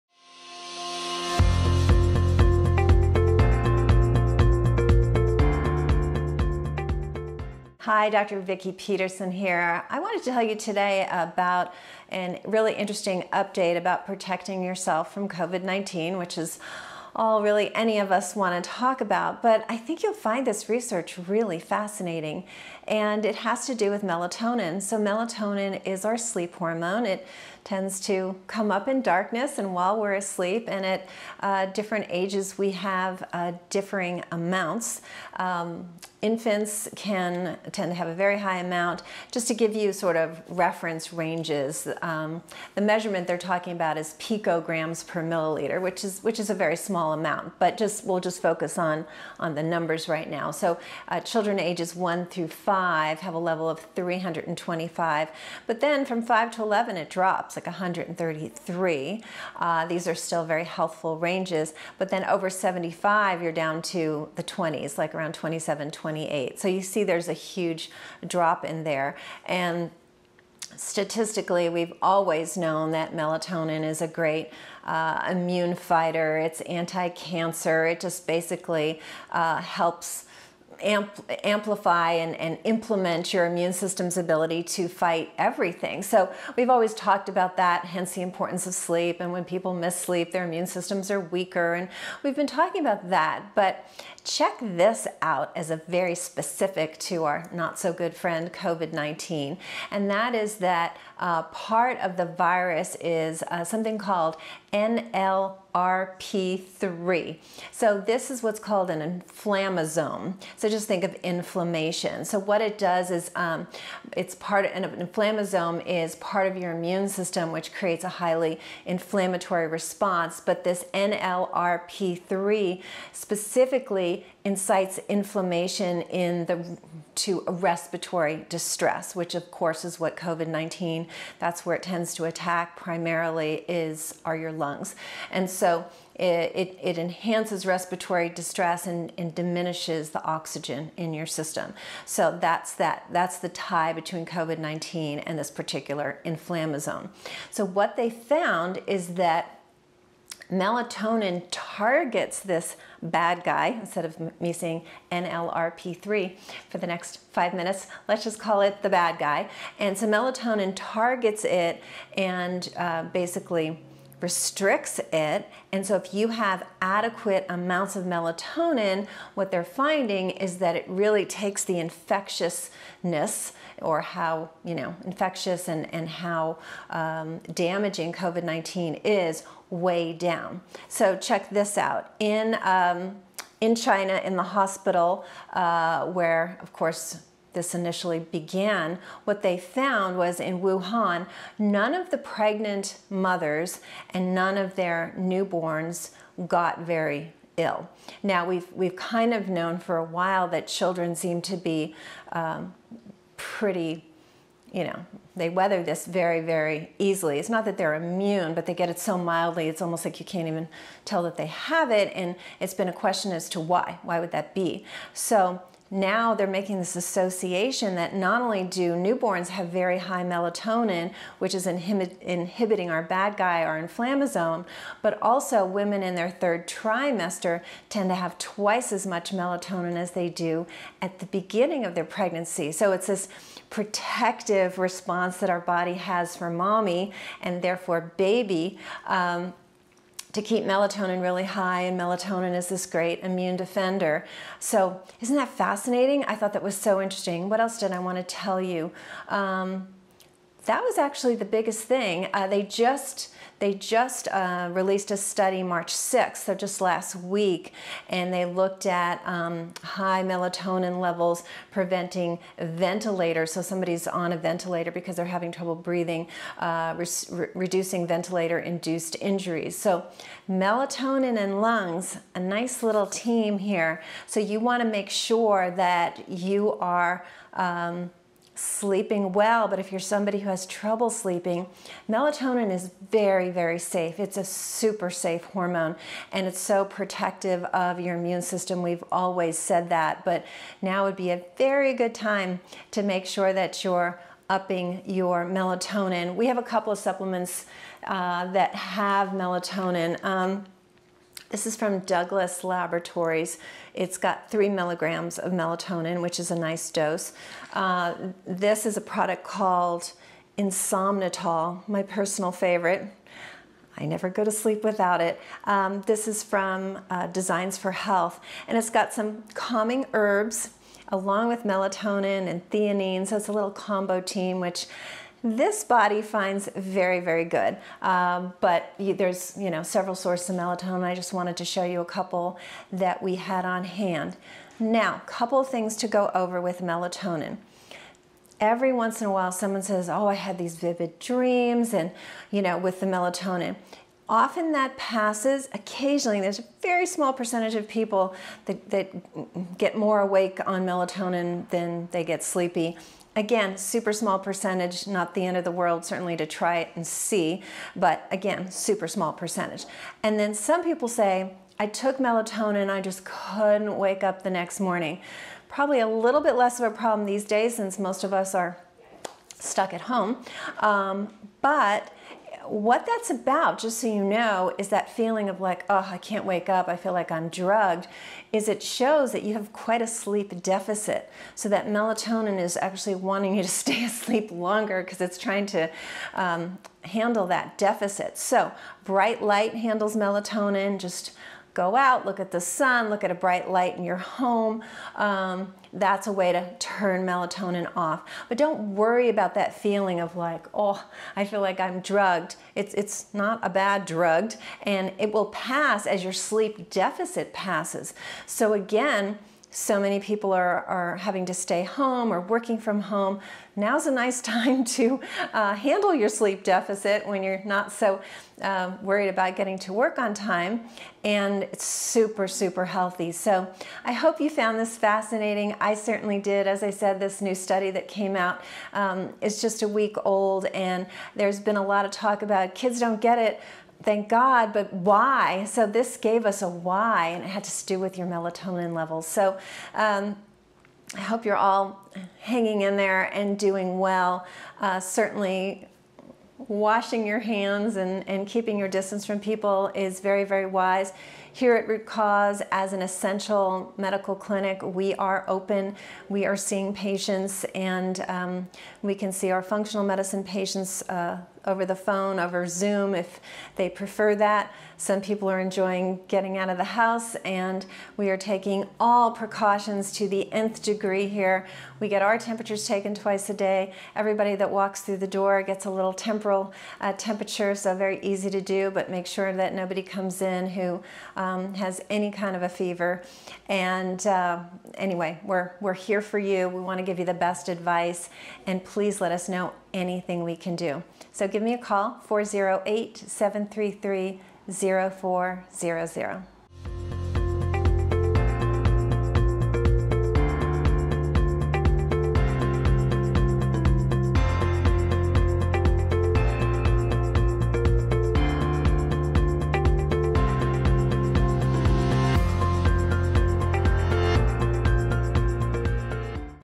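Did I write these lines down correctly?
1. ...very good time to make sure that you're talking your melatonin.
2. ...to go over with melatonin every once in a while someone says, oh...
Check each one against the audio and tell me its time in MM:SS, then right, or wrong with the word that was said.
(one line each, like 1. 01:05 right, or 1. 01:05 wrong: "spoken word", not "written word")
1. 04:51 wrong: "upping", not "talking"
2. 05:35 right.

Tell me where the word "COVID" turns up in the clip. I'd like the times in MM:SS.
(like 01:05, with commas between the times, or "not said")
00:15, 01:38, 02:10, 02:24, 02:58.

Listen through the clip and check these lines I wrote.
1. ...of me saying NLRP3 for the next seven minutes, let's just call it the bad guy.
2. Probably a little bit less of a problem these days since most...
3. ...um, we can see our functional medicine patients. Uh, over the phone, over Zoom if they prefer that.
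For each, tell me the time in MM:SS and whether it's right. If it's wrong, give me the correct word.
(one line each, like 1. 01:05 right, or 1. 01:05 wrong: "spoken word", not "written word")
1. 02:34 wrong: "five", not "seven"
2. 06:05 right
3. 07:38 right.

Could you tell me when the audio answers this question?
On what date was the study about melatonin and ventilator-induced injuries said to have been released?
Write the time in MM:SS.
04:15.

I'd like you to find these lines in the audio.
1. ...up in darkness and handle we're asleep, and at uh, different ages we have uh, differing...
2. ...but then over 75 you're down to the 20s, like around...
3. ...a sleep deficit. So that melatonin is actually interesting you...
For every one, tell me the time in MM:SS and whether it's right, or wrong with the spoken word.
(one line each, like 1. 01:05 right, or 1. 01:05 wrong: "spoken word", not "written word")
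1. 00:28 wrong: "while", not "handle"
2. 01:01 right
3. 06:20 wrong: "wanting", not "interesting".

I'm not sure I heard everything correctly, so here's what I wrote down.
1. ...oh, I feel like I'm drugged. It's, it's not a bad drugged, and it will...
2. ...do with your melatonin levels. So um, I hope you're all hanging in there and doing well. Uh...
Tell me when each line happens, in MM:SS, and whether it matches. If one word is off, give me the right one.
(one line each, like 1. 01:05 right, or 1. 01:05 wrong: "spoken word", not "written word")
1. 06:40 right
2. 07:17 right.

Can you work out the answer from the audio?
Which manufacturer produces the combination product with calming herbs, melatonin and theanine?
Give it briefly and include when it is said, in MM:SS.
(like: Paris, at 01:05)
Designs for Health, at 05:17.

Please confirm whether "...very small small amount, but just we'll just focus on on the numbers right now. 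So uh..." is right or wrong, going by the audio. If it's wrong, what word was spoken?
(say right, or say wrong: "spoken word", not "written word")
right.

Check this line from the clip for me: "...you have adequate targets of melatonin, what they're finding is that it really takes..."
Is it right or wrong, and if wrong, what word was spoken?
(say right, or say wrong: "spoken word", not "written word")
wrong: "amounts", not "targets".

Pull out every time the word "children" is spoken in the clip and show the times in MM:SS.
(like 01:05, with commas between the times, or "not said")
00:51, 03:20.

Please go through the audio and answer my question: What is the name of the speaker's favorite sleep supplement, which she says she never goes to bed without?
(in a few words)
Insomnitol.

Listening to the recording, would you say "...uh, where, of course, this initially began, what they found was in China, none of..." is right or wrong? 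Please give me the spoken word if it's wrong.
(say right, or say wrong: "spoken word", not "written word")
wrong: "Wuhan", not "China".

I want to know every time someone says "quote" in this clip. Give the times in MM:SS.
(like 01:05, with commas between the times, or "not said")
not said.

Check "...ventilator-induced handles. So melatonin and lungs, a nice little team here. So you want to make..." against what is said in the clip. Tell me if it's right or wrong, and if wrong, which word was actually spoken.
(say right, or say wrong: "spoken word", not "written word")
wrong: "injuries", not "handles".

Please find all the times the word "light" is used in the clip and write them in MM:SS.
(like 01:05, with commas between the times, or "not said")
06:29, 06:33.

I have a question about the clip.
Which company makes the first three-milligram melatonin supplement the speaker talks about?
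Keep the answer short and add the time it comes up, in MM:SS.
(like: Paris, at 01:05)
Douglas Laboratories, at 05:01.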